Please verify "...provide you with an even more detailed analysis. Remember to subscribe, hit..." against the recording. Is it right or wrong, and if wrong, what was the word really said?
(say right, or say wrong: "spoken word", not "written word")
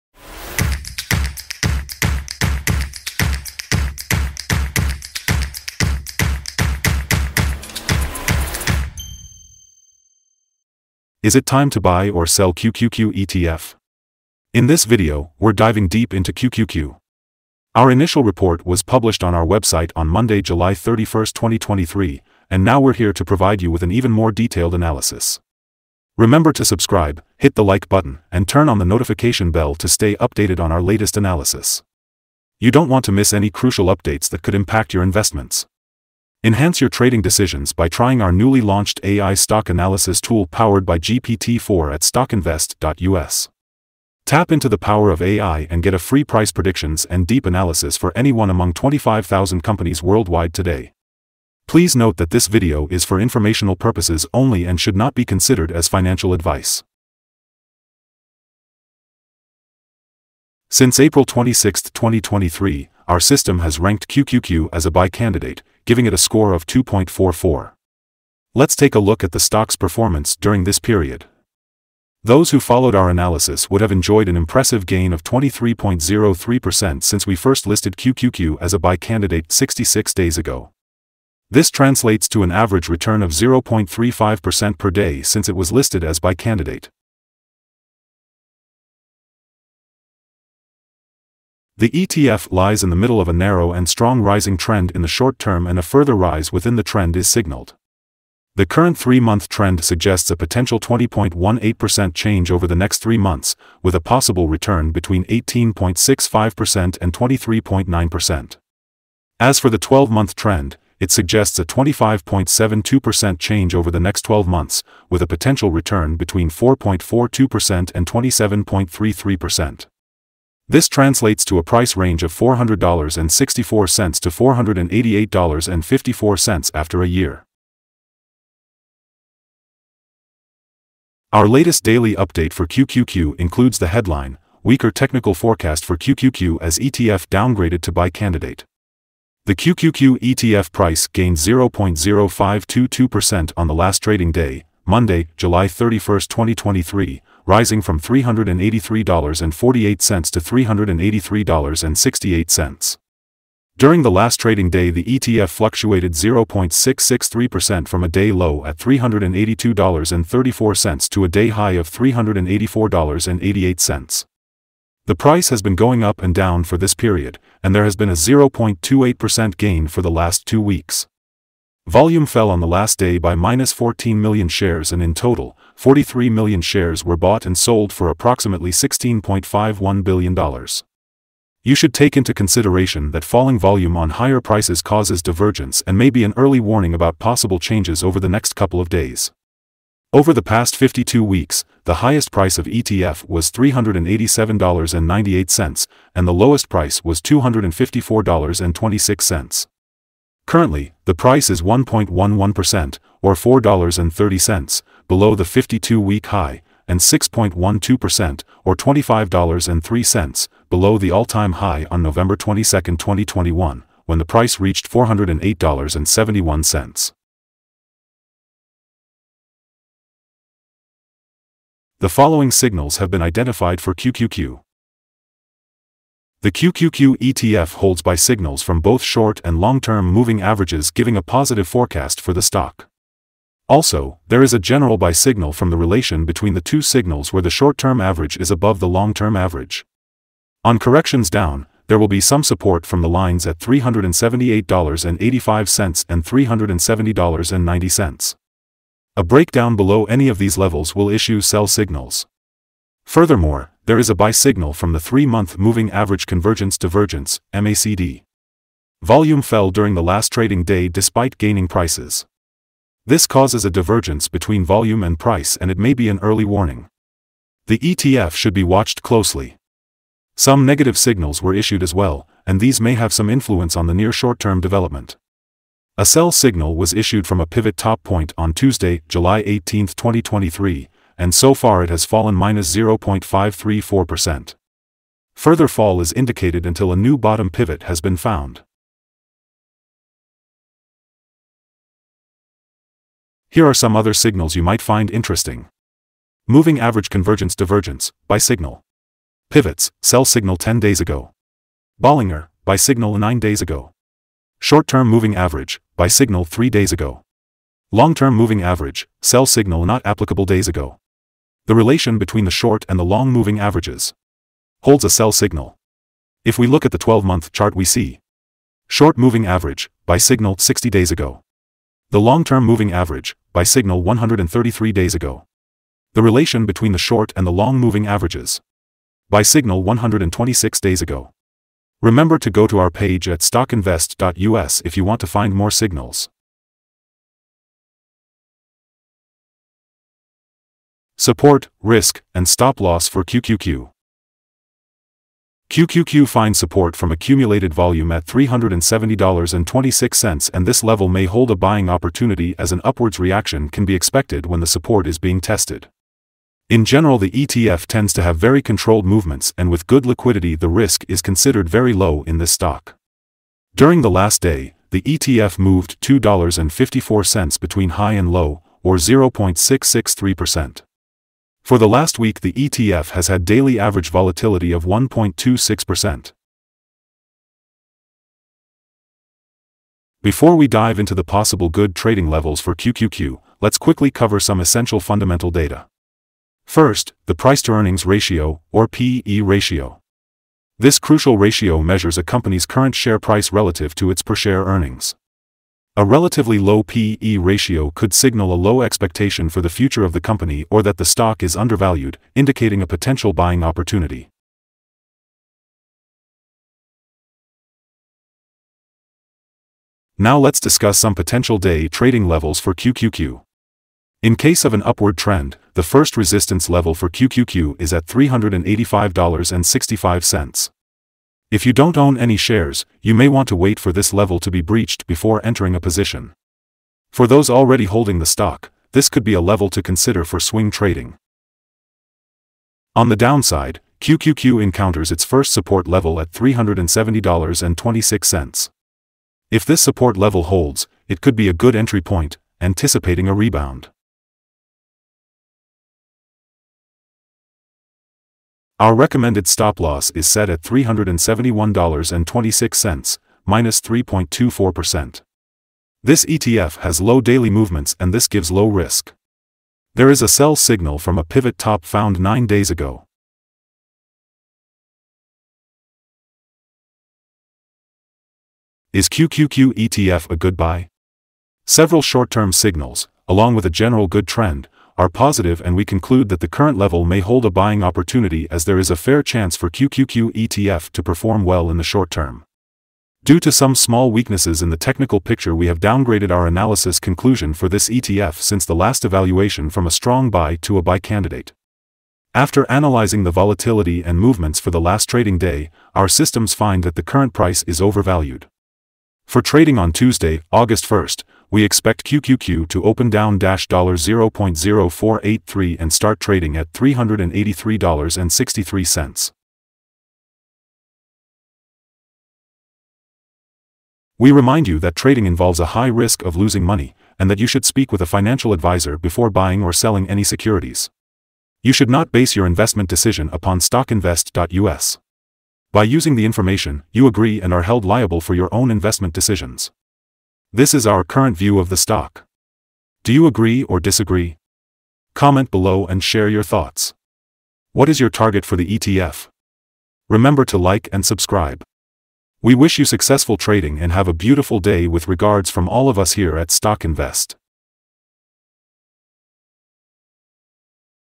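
right.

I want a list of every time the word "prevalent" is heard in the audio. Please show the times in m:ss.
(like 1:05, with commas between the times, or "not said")
not said.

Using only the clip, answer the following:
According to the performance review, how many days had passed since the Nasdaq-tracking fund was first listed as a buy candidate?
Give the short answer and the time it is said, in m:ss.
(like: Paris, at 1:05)
66, at 1:19.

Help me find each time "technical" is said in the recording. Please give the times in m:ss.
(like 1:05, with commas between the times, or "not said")
2:14, 8:04.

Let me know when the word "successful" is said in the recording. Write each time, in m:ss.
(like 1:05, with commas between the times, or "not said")
9:02.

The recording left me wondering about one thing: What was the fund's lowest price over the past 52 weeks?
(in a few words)
$254.26.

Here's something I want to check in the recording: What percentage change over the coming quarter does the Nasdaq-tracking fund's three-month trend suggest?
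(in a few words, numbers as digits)
20.18%.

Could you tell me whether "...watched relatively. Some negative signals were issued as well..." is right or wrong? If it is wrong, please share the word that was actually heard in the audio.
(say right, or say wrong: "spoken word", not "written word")
wrong: "closely", not "relatively".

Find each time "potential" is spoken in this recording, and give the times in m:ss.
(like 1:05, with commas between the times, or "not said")
1:40, 1:55, 6:42, 6:51.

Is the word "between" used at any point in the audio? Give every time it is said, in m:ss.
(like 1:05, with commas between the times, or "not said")
1:44, 1:56, 3:56, 4:24, 5:12, 5:26, 6:07.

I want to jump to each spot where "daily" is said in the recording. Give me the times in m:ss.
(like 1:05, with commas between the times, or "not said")
2:11, 6:13, 7:37.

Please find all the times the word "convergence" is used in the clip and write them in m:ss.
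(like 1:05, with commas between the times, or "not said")
4:16, 4:57.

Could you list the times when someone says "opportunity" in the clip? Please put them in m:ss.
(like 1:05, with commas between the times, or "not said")
5:51, 6:43, 7:57.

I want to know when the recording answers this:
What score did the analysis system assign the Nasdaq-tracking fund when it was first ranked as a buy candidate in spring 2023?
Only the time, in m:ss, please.
1:06.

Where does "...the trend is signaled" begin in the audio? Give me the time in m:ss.
1:36.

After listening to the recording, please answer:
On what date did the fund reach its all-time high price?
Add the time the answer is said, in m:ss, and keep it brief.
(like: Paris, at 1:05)
November 22, 2021, at 3:32.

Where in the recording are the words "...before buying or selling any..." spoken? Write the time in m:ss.
8:38.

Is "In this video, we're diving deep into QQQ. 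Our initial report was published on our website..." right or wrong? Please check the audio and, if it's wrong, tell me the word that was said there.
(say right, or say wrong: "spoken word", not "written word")
right.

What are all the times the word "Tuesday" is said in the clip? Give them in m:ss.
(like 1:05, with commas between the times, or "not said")
4:38, 8:19.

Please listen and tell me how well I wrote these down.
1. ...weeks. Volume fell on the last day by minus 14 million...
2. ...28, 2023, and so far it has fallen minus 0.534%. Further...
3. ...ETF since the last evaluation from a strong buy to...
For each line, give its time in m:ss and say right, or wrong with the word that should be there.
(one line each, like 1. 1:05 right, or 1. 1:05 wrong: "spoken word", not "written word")
1. 2:50 right
2. 4:39 wrong: "18", not "28"
3. 8:07 right.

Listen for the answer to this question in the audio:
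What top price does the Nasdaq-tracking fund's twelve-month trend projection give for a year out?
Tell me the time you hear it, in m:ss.
2:04.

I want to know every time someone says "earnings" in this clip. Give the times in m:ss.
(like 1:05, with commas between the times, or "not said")
6:27, 6:34.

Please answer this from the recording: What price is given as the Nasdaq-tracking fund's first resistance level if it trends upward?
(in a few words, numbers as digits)
$385.65.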